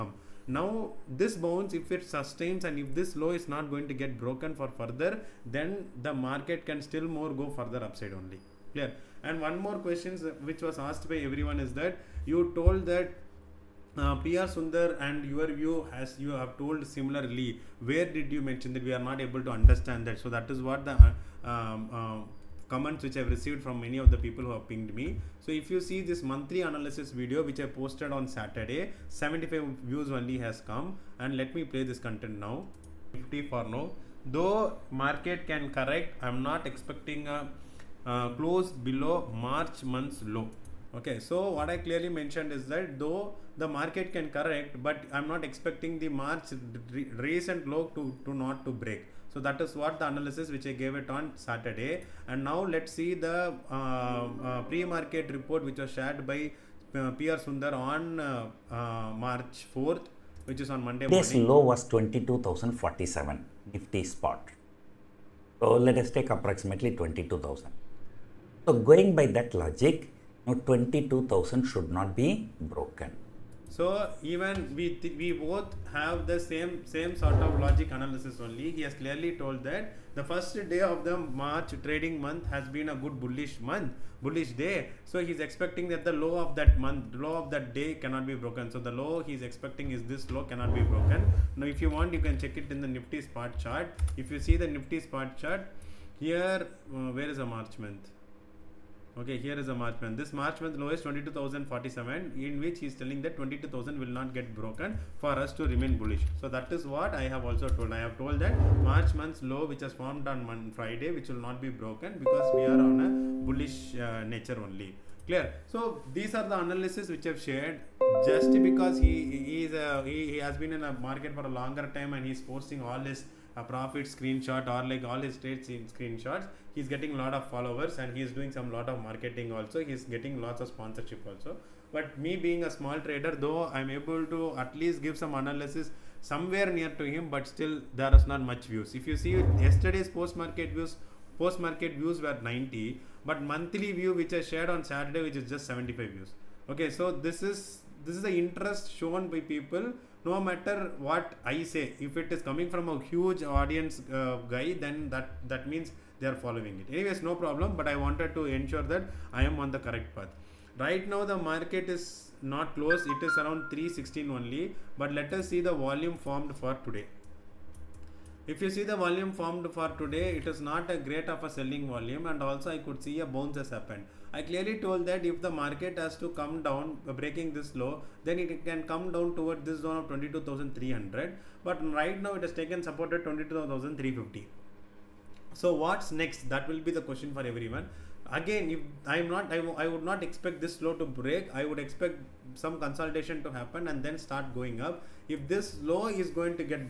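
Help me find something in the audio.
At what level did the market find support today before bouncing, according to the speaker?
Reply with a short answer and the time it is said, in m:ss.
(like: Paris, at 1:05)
22,350, at 3:03.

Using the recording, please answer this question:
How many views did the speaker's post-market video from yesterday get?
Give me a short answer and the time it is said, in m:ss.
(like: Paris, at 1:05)
90, at 2:21.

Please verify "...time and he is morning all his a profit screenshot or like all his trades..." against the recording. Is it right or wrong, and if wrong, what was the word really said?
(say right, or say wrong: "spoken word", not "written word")
wrong: "posting", not "morning".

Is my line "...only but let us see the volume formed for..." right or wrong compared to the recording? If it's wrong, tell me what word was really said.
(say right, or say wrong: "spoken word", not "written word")
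right.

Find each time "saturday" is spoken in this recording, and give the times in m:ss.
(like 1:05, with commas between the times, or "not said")
0:28, 0:51, 2:24.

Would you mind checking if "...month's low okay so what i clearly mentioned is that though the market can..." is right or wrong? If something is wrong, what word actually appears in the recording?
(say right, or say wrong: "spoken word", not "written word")
right.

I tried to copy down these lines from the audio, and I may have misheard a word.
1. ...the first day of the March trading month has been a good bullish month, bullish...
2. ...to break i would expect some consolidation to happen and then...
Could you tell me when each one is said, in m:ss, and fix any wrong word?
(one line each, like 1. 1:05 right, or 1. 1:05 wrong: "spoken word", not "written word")
1. 1:20 right
2. 3:10 right.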